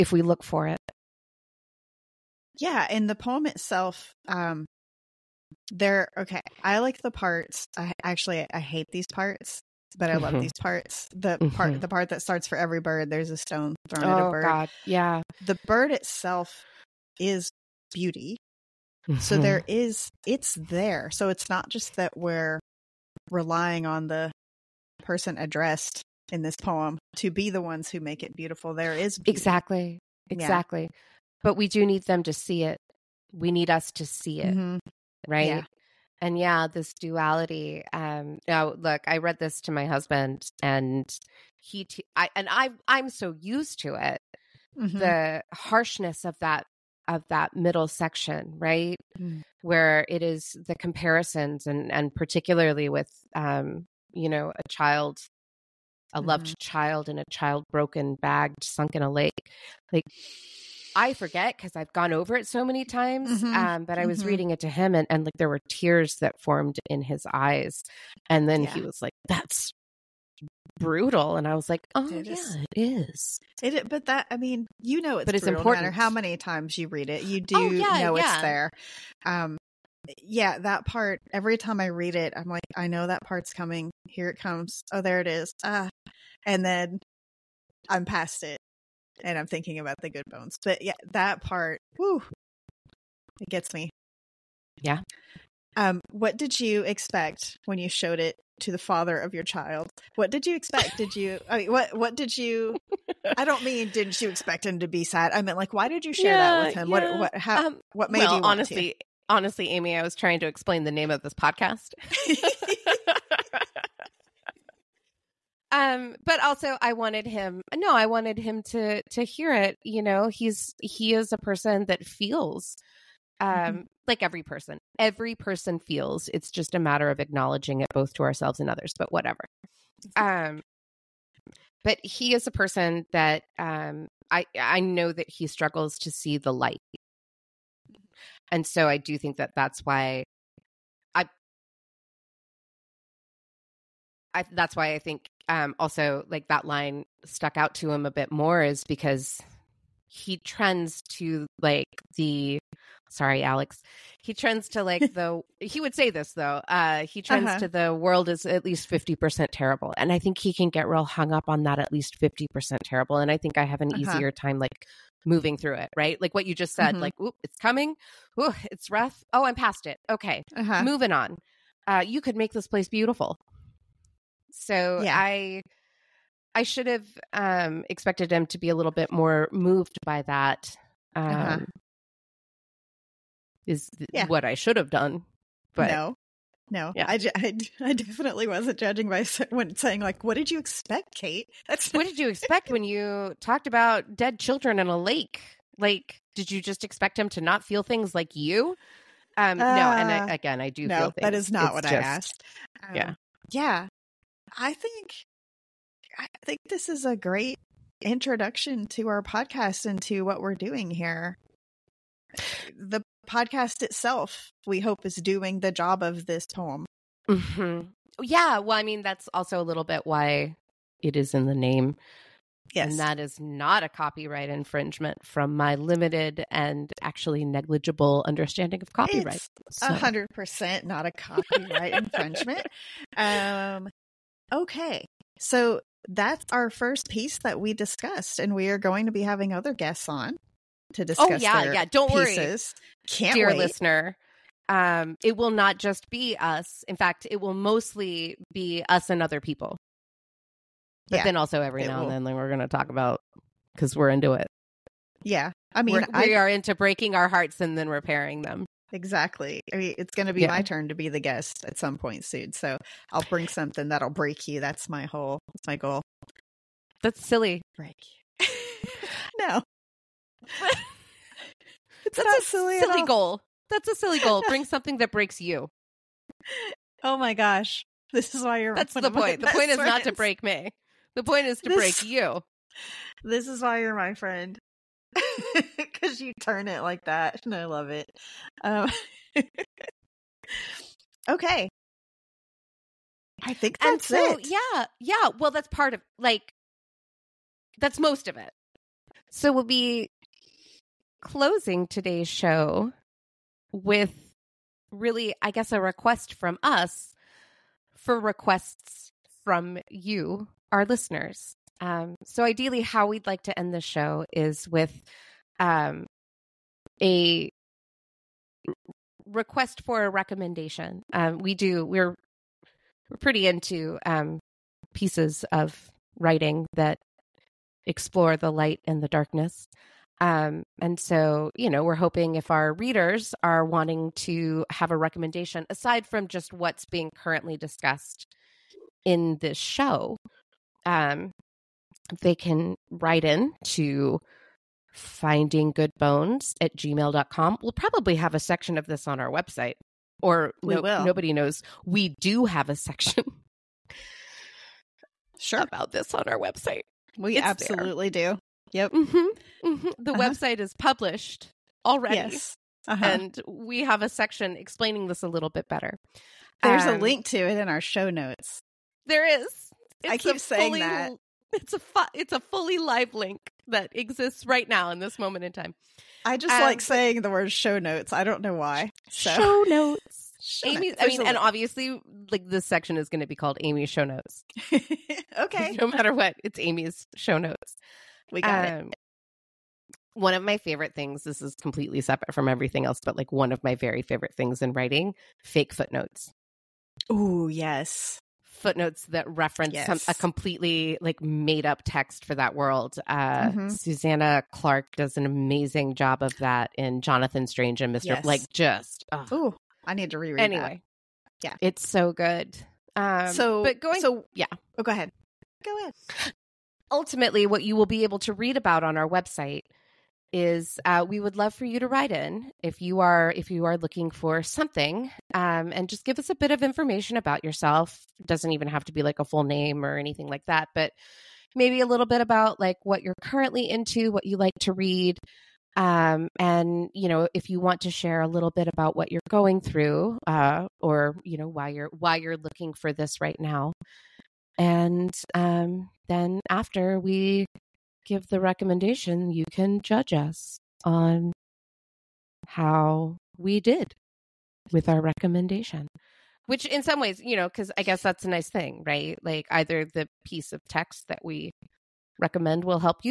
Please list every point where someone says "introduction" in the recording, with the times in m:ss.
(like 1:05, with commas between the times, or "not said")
3:28.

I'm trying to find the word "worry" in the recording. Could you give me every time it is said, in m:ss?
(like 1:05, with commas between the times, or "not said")
4:02.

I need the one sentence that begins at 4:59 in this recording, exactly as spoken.
So we'll be closing today's show with really, I guess, a request from us for requests from you, our listeners.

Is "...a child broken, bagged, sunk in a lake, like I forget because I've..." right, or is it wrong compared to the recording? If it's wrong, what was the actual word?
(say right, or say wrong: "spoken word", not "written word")
right.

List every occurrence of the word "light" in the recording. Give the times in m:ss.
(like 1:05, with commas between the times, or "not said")
2:16, 5:28.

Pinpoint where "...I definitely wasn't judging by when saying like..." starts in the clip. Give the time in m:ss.
3:07.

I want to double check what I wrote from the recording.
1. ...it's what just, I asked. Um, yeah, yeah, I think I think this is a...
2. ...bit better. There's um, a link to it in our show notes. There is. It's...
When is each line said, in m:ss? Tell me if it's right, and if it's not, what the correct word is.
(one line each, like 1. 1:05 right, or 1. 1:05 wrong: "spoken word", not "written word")
1. 3:21 right
2. 6:05 right.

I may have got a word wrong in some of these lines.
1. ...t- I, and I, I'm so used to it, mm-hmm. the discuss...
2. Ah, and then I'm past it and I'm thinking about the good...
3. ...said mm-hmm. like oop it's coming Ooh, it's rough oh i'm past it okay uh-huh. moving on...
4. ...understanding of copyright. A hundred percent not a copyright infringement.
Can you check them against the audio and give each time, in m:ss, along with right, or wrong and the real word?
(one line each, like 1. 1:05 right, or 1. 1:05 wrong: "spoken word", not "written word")
1. 0:41 wrong: "harshness", not "discuss"
2. 1:25 right
3. 2:46 right
4. 3:48 right.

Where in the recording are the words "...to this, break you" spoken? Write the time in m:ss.
4:41.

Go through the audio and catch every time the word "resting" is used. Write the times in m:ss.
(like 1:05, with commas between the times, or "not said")
not said.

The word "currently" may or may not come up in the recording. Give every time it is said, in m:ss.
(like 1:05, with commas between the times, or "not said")
5:37, 7:13.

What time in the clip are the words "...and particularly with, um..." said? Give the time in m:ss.
0:51.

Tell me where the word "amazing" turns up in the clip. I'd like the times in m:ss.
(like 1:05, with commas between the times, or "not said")
6:45.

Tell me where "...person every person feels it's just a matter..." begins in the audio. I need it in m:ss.
2:04.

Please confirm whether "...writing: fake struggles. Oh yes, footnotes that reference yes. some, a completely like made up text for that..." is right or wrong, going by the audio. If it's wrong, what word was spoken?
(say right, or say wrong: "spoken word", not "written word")
wrong: "footnotes", not "struggles".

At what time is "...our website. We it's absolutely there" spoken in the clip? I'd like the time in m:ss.
5:56.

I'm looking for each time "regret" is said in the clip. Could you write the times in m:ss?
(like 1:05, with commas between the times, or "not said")
not said.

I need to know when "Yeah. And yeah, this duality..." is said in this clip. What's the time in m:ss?
0:35.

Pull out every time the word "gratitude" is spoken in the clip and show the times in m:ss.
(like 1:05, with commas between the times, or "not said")
not said.